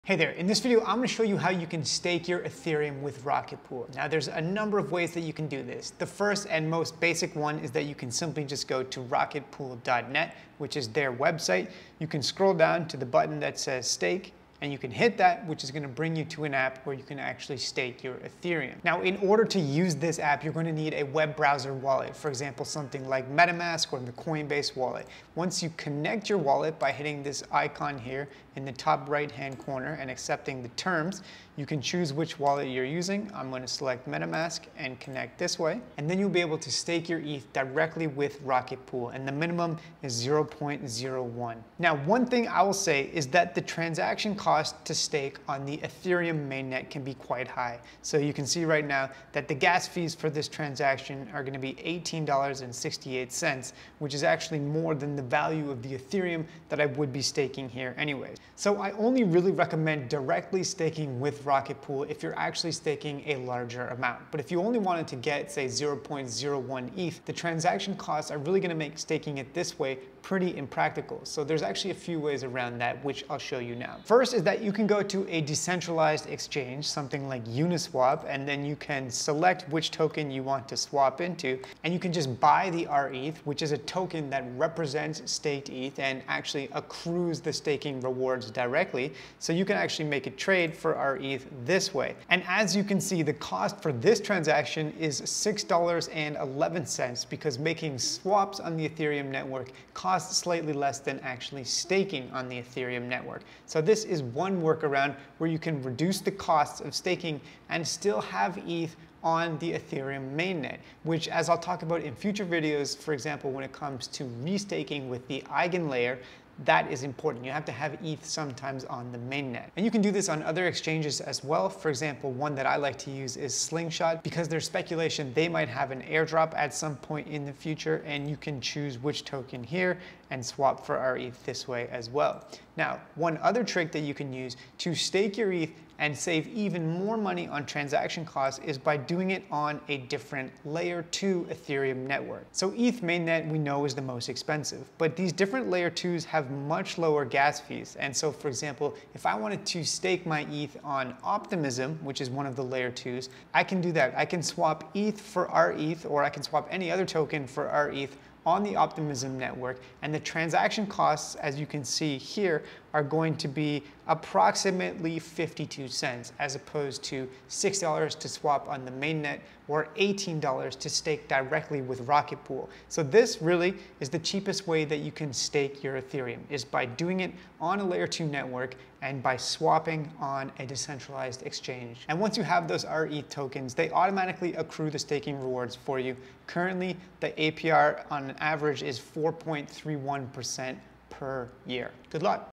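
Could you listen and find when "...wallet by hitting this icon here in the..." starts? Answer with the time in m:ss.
0:26.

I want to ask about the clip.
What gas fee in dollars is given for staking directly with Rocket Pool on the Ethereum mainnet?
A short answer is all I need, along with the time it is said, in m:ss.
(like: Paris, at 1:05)
$18.68, at 0:51.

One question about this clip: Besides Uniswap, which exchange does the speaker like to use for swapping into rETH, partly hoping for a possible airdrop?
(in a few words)
Slingshot.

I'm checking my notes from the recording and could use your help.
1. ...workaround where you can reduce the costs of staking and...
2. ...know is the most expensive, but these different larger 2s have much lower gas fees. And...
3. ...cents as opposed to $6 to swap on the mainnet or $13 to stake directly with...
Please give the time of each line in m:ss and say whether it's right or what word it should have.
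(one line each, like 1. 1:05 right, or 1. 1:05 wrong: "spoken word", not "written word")
1. 1:44 right
2. 2:23 wrong: "layer", not "larger"
3. 2:45 wrong: "18", not "13".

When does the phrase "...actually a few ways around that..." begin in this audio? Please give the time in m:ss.
1:11.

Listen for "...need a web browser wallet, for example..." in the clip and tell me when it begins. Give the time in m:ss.
0:20.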